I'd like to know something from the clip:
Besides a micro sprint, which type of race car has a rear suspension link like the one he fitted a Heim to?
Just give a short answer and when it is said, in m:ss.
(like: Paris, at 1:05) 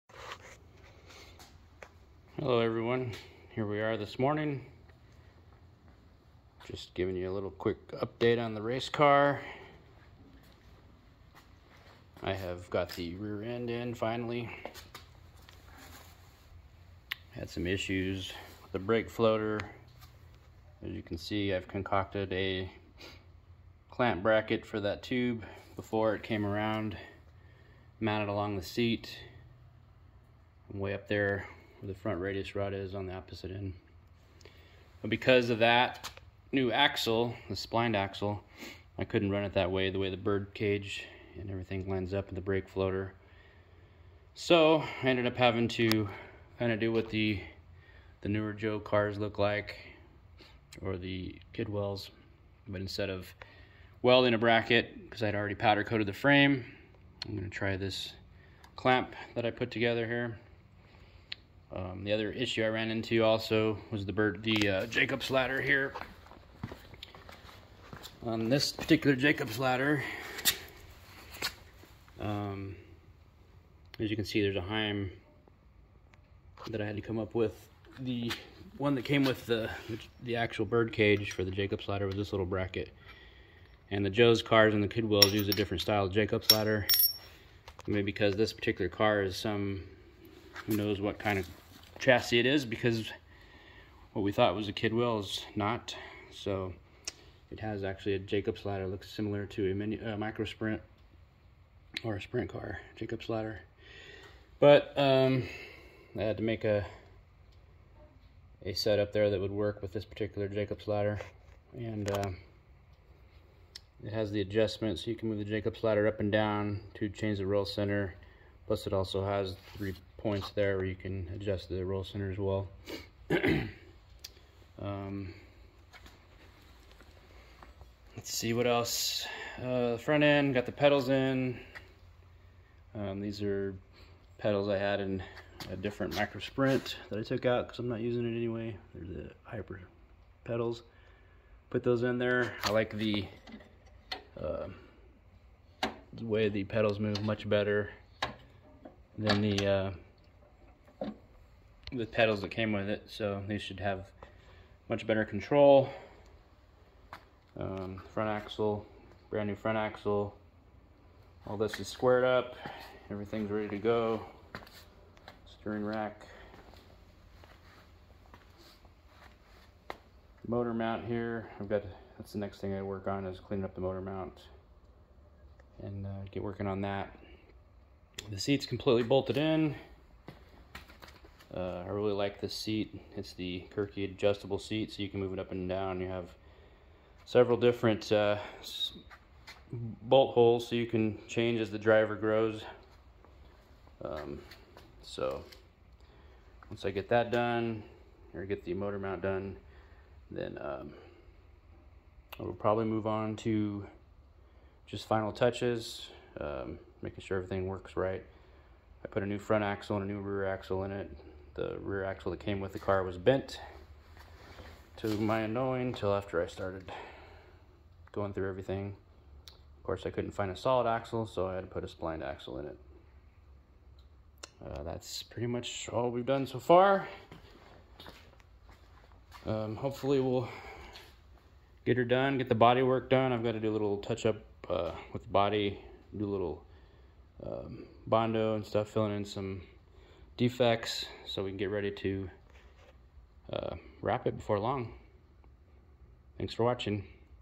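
sprint car, at 1:42.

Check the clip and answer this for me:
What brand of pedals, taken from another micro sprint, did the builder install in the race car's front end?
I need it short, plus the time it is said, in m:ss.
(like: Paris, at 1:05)
Hyper, at 2:19.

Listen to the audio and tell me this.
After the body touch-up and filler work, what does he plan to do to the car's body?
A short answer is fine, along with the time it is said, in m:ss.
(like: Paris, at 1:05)
Wrap it, at 4:04.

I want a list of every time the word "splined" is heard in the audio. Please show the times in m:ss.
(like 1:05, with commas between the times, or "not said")
0:37, 3:41.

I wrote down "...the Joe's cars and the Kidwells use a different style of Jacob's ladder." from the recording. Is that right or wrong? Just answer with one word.
right.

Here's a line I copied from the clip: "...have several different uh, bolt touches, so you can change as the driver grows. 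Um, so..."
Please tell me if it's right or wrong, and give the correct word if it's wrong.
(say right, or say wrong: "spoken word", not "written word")
wrong: "holes", not "touches".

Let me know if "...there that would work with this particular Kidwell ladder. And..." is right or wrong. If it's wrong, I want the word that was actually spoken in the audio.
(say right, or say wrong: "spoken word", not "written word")
wrong: "Jacobs", not "Kidwell".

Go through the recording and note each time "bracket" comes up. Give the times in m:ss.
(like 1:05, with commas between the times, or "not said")
0:24, 0:54, 1:22.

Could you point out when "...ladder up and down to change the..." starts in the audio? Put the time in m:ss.
1:55.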